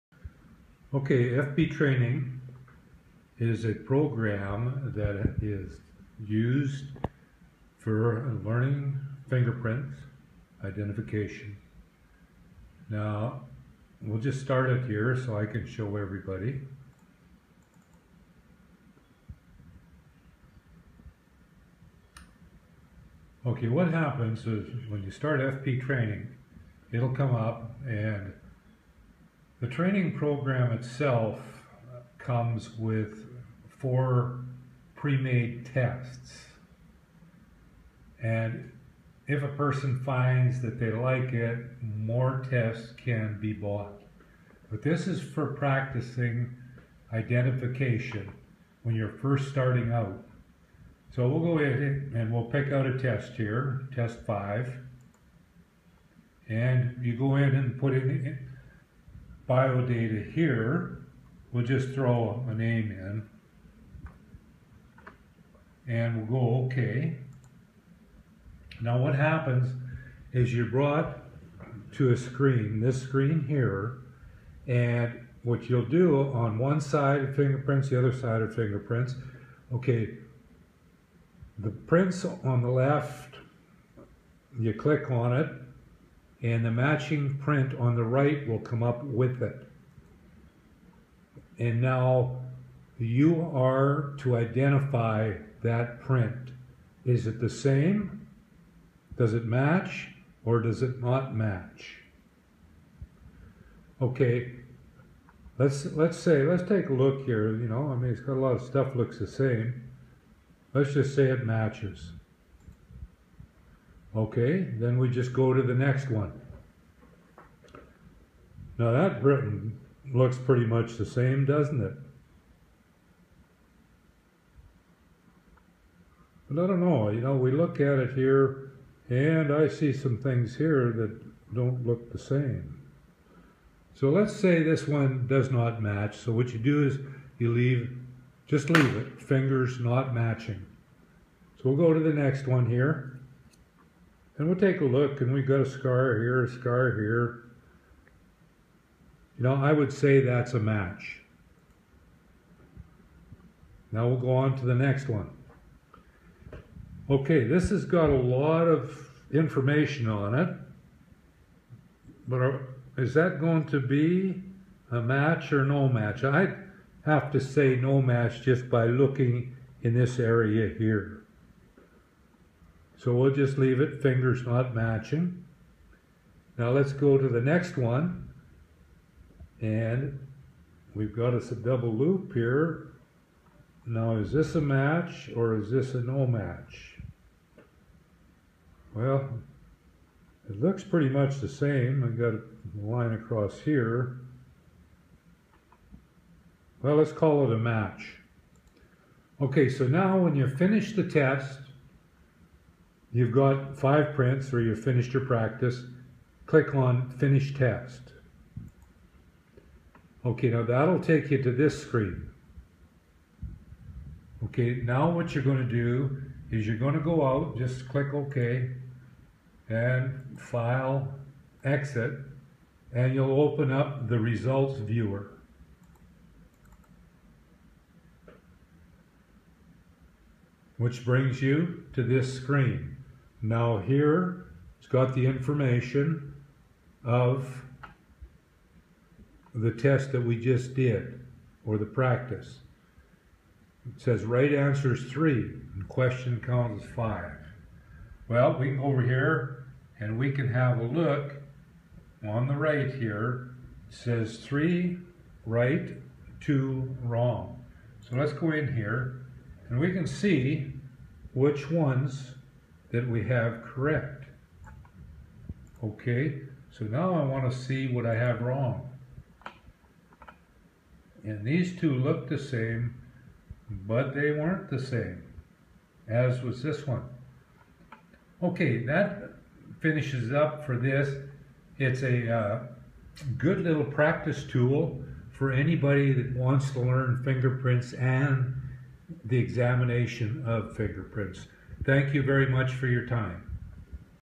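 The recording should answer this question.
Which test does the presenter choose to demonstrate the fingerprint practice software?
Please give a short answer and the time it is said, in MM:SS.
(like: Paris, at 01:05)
test five, at 00:53.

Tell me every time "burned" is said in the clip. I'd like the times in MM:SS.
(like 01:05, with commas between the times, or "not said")
not said.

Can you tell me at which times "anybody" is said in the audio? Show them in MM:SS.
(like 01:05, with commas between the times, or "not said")
04:45.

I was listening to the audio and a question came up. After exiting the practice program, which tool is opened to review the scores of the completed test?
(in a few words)
Results Viewer.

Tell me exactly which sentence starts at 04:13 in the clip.
It says three right, two wrong.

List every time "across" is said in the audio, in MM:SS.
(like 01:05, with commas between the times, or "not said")
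03:13.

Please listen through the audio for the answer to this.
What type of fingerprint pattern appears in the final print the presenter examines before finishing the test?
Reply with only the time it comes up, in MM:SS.
03:01.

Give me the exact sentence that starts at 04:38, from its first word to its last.
Okay, that finishes up for this.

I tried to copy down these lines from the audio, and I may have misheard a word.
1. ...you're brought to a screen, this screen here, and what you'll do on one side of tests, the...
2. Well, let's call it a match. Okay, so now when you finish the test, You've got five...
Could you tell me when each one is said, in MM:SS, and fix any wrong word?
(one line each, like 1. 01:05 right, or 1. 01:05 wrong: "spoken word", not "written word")
1. 01:10 wrong: "fingerprints", not "tests"
2. 03:16 right.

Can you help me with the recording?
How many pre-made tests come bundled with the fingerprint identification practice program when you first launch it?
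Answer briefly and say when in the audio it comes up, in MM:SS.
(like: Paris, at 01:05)
4, at 00:33.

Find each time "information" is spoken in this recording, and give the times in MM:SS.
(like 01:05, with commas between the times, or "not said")
02:39, 03:55.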